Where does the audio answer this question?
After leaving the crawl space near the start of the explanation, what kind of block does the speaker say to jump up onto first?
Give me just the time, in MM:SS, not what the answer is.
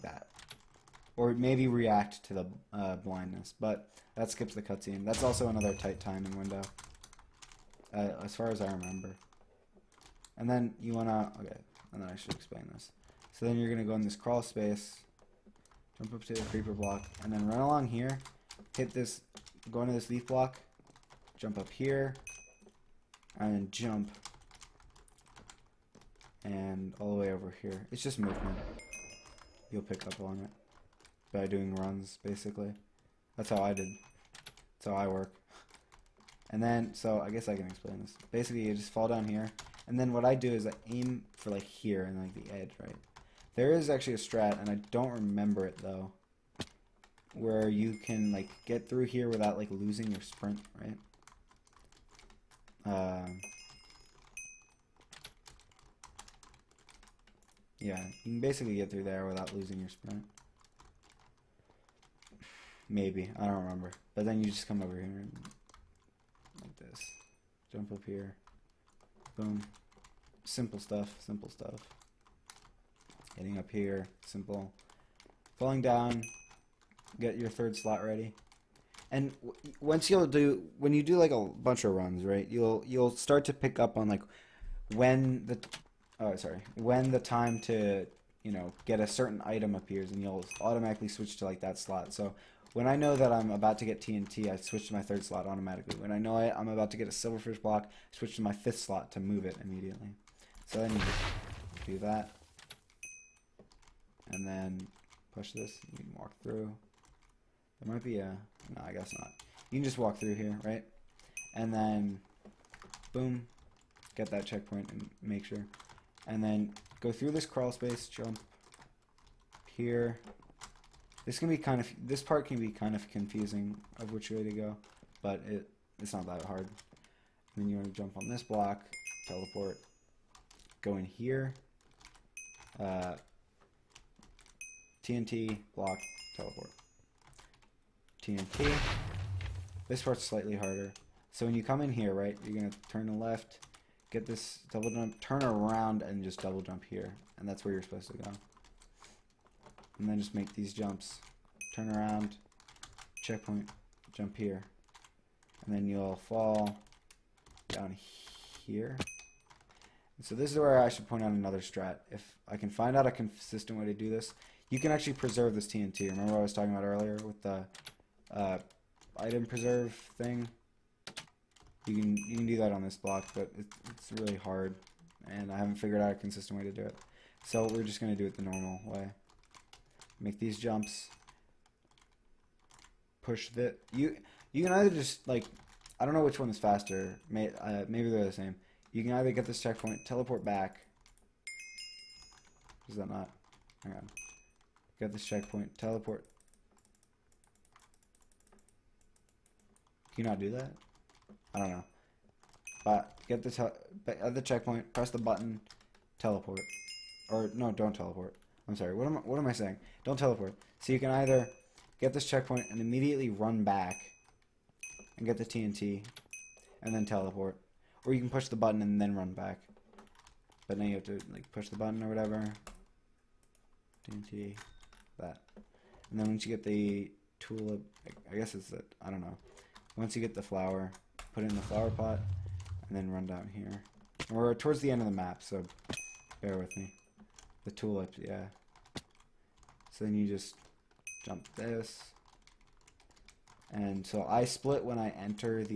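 00:16.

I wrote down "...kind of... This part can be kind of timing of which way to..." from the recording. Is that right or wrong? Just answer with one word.
wrong.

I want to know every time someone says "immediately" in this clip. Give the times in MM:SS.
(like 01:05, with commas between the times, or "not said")
01:39, 03:32.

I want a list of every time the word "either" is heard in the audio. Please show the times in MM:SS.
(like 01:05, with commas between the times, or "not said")
03:04, 03:09, 03:31.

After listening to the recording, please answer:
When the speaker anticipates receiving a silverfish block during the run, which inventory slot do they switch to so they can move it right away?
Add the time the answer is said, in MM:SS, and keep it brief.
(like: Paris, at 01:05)
fifth slot, at 01:38.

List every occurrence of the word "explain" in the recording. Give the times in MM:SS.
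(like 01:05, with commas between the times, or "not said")
00:12, 00:37.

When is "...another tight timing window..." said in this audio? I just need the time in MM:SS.
00:05.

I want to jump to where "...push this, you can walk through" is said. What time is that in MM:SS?
01:45.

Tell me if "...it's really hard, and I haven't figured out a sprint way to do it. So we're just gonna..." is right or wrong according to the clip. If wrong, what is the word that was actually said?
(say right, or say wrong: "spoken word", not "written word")
wrong: "consistent", not "sprint".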